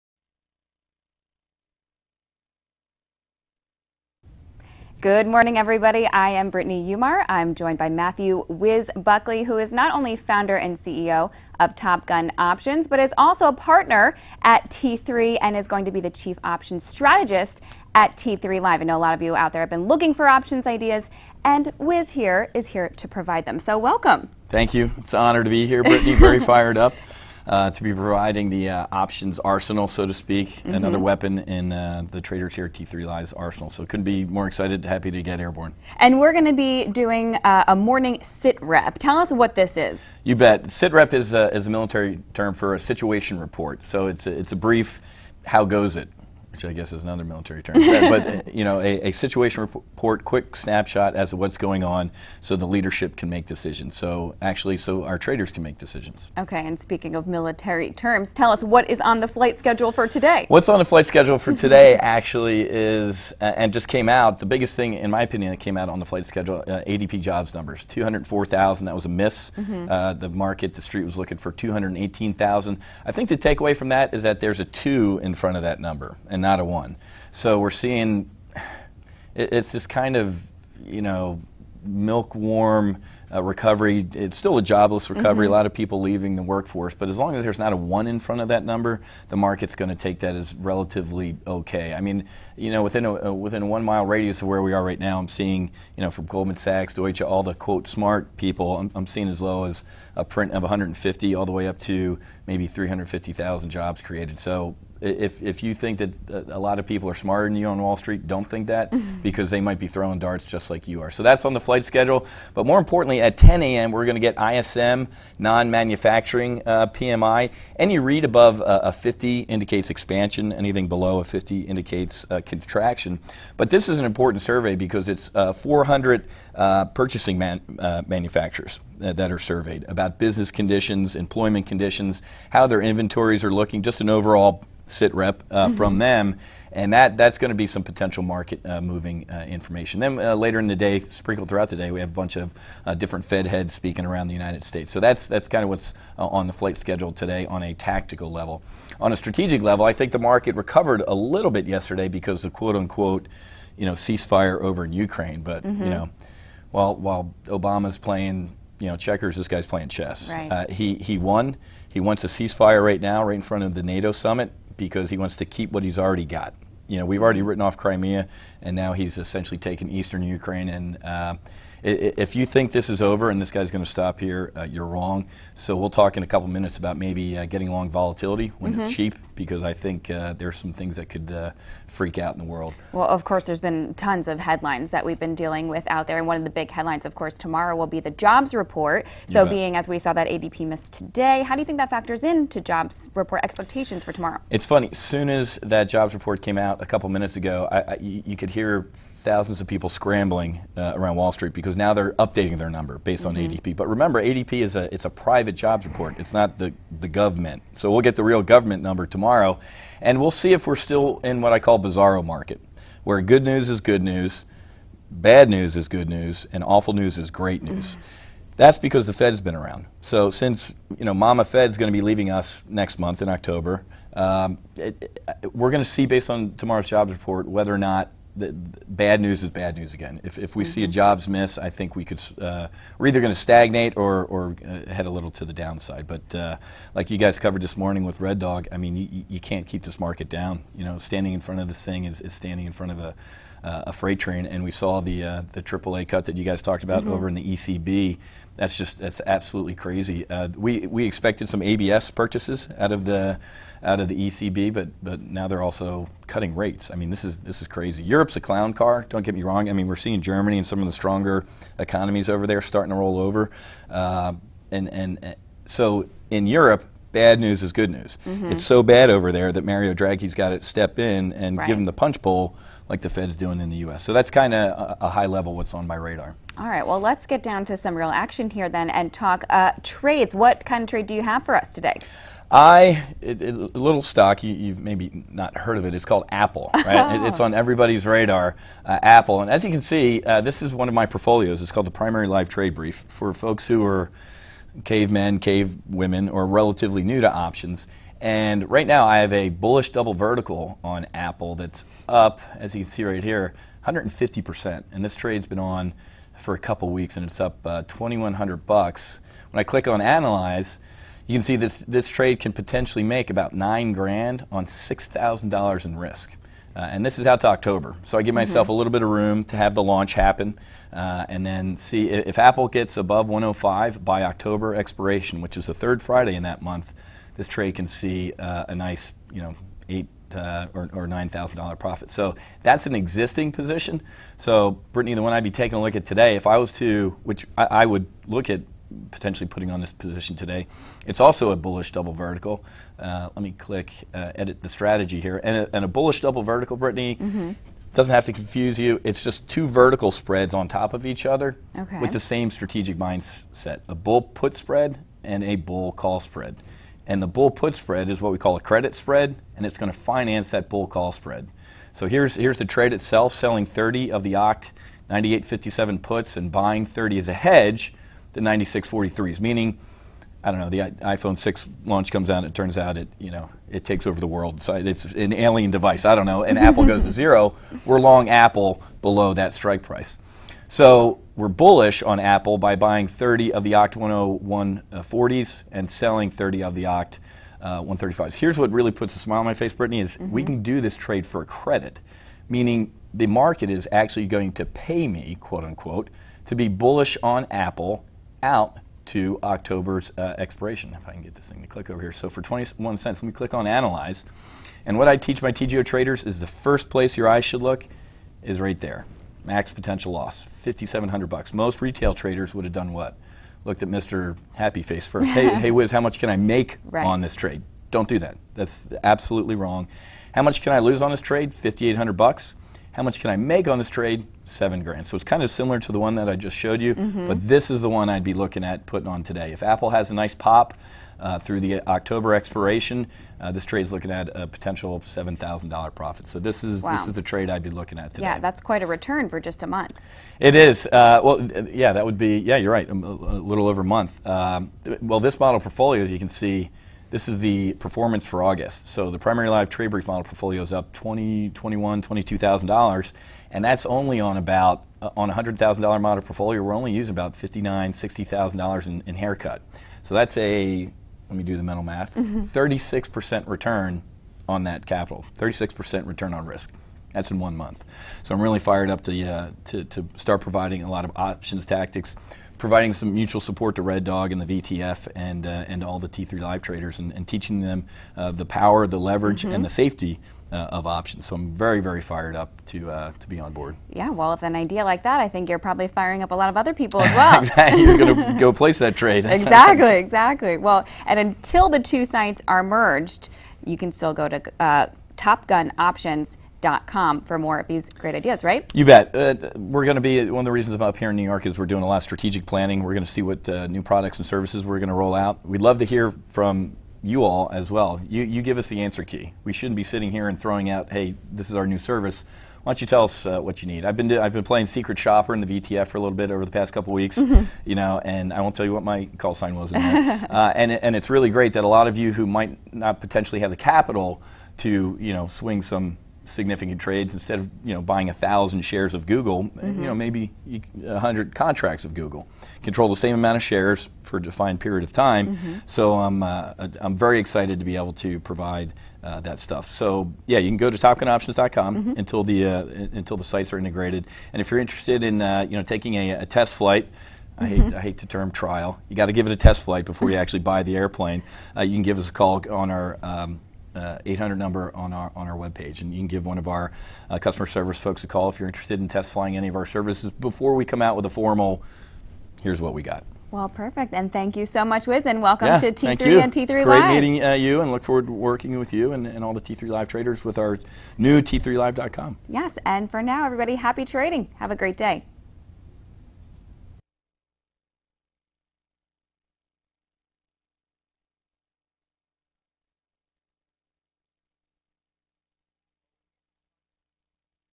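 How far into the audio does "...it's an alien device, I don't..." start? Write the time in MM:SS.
06:14.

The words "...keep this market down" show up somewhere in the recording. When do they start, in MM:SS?
03:59.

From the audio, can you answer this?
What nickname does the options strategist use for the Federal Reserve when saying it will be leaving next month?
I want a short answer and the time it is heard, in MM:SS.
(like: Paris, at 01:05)
Mama Fed, at 03:41.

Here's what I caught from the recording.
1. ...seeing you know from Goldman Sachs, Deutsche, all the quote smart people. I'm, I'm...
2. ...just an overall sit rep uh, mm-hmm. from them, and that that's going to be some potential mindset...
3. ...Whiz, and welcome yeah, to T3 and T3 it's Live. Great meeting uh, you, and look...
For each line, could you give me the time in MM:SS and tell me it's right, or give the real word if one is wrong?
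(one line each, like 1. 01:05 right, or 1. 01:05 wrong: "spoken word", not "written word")
1. 01:35 right
2. 02:13 wrong: "market", not "mindset"
3. 09:24 right.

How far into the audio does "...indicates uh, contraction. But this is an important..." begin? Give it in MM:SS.
02:01.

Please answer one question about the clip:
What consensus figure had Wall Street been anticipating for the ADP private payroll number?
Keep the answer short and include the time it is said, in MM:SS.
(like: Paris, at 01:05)
218,000, at 01:11.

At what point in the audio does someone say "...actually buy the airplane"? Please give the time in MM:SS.
09:10.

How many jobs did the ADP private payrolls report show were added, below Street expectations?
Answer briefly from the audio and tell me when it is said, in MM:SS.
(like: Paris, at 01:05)
204,000, at 01:07.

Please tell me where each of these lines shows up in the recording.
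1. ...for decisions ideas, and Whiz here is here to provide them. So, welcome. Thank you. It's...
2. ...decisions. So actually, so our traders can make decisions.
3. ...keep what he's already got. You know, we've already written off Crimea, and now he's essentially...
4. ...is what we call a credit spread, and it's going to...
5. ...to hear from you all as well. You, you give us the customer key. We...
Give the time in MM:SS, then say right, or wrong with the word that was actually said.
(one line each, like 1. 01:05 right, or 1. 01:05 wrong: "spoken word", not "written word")
1. 00:20 wrong: "options", not "decisions"
2. 00:53 right
3. 02:45 right
4. 05:58 right
5. 08:25 wrong: "answer", not "customer".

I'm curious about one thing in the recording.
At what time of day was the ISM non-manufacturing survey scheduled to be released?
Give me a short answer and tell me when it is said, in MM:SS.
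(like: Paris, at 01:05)
10 a.m., at 01:53.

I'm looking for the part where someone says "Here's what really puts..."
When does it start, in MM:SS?
06:28.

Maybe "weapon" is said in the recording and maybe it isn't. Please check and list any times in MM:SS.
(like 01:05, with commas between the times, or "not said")
00:30.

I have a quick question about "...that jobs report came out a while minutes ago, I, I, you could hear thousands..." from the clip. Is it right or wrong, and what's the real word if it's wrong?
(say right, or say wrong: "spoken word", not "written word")
wrong: "couple", not "while".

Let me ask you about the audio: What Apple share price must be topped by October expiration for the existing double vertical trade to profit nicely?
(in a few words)
105.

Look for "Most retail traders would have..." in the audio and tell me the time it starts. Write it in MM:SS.
06:51.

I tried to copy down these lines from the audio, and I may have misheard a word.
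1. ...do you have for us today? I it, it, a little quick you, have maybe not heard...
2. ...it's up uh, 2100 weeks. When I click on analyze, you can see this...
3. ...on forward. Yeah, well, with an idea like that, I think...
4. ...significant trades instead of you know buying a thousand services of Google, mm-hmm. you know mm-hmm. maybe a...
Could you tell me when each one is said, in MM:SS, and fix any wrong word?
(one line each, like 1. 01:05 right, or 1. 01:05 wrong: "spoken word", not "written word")
1. 04:41 wrong: "stock", not "quick"
2. 05:07 wrong: "bucks", not "weeks"
3. 08:03 wrong: "board", not "forward"
4. 08:46 wrong: "shares", not "services".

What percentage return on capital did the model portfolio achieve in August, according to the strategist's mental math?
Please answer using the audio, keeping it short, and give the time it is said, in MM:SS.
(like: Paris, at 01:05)
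36 percent, at 07:45.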